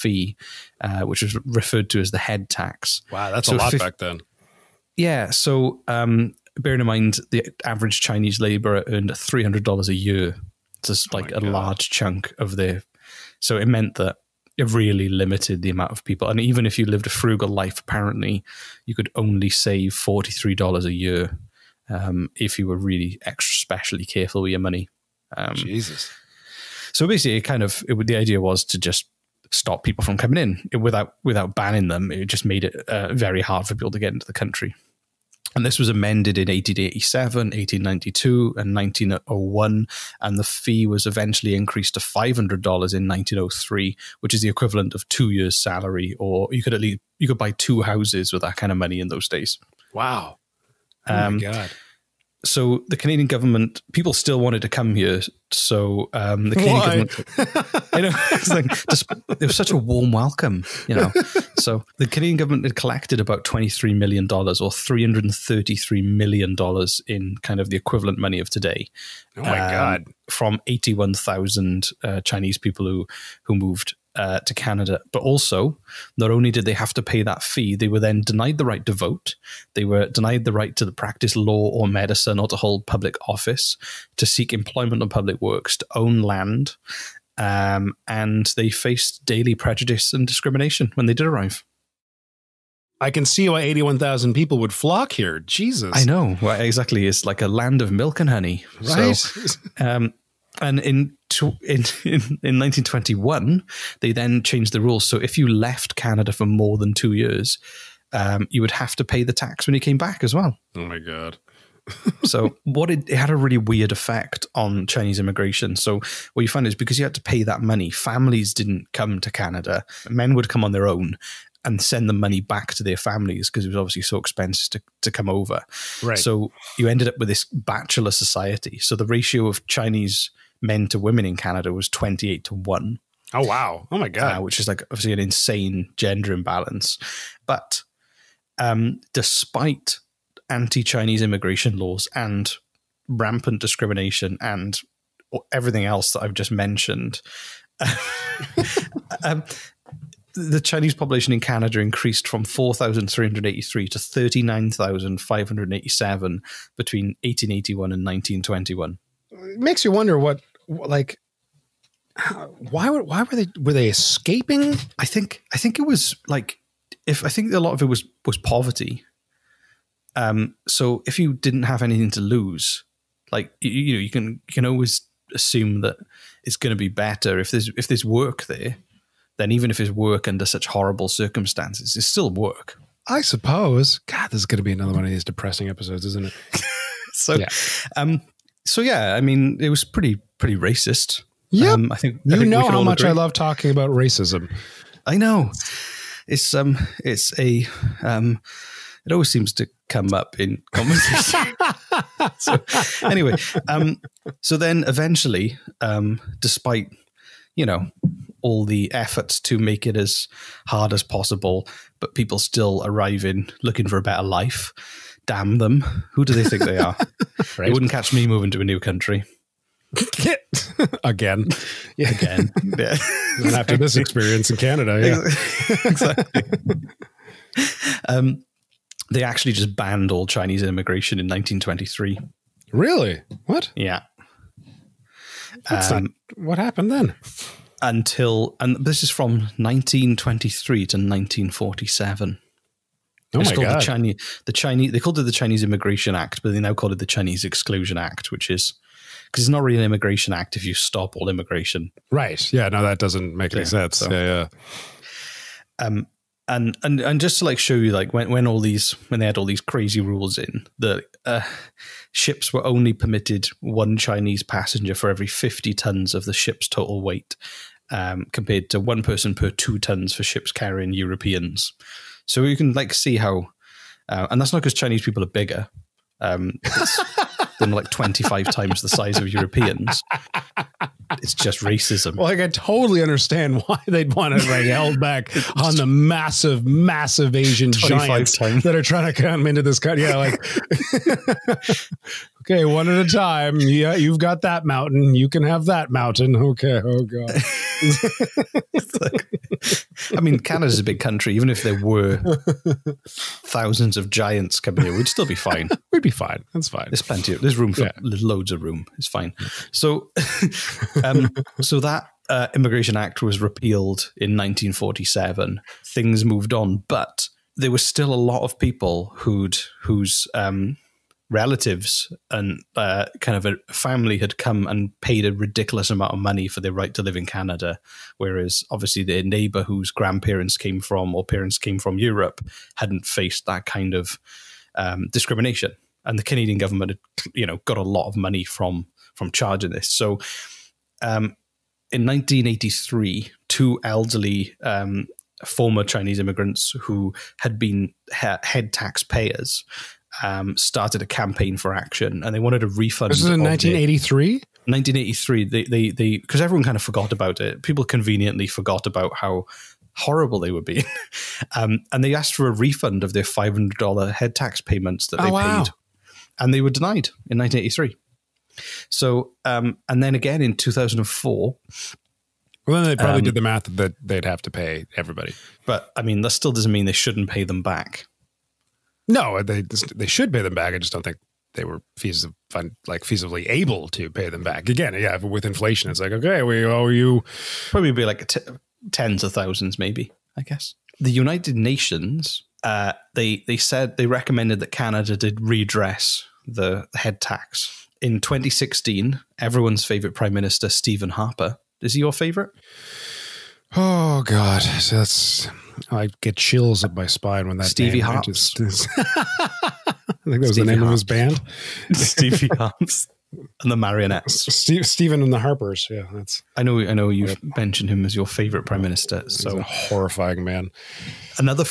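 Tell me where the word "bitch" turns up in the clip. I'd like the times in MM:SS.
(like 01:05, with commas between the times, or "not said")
not said.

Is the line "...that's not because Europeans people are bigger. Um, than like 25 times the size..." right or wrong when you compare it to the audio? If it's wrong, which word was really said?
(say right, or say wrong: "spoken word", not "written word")
wrong: "Chinese", not "Europeans".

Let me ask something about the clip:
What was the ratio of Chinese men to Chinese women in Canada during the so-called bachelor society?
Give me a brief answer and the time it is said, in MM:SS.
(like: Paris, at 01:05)
28 to 1, at 02:11.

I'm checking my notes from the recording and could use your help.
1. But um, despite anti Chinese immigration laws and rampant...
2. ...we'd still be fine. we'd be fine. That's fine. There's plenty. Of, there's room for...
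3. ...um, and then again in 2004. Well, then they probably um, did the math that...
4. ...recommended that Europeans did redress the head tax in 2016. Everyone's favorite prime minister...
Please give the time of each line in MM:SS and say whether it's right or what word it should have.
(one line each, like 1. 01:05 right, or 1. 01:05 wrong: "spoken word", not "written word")
1. 02:17 right
2. 05:04 right
3. 06:09 right
4. 06:34 wrong: "Canada", not "Europeans".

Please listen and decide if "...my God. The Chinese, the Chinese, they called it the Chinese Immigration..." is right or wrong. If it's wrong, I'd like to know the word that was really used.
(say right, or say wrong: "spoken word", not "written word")
right.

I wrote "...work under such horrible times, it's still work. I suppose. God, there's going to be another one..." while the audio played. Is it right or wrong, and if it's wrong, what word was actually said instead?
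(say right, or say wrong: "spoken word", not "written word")
wrong: "circumstances", not "times".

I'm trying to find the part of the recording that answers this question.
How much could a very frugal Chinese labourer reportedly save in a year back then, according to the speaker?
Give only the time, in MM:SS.
00:19.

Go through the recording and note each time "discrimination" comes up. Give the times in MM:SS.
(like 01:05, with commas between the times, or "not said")
01:30, 02:23, 05:35.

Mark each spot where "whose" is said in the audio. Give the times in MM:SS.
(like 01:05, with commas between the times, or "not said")
05:19, 05:29.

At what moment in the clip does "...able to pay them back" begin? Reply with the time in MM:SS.
06:23.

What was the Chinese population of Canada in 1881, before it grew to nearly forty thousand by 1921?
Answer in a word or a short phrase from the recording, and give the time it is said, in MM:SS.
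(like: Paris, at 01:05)
4,383, at 02:32.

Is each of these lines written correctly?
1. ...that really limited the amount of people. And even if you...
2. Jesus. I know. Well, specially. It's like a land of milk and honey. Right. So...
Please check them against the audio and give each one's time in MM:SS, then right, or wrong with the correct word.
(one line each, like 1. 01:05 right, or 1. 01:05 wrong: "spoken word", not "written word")
1. 00:13 right
2. 01:35 wrong: "exactly", not "specially".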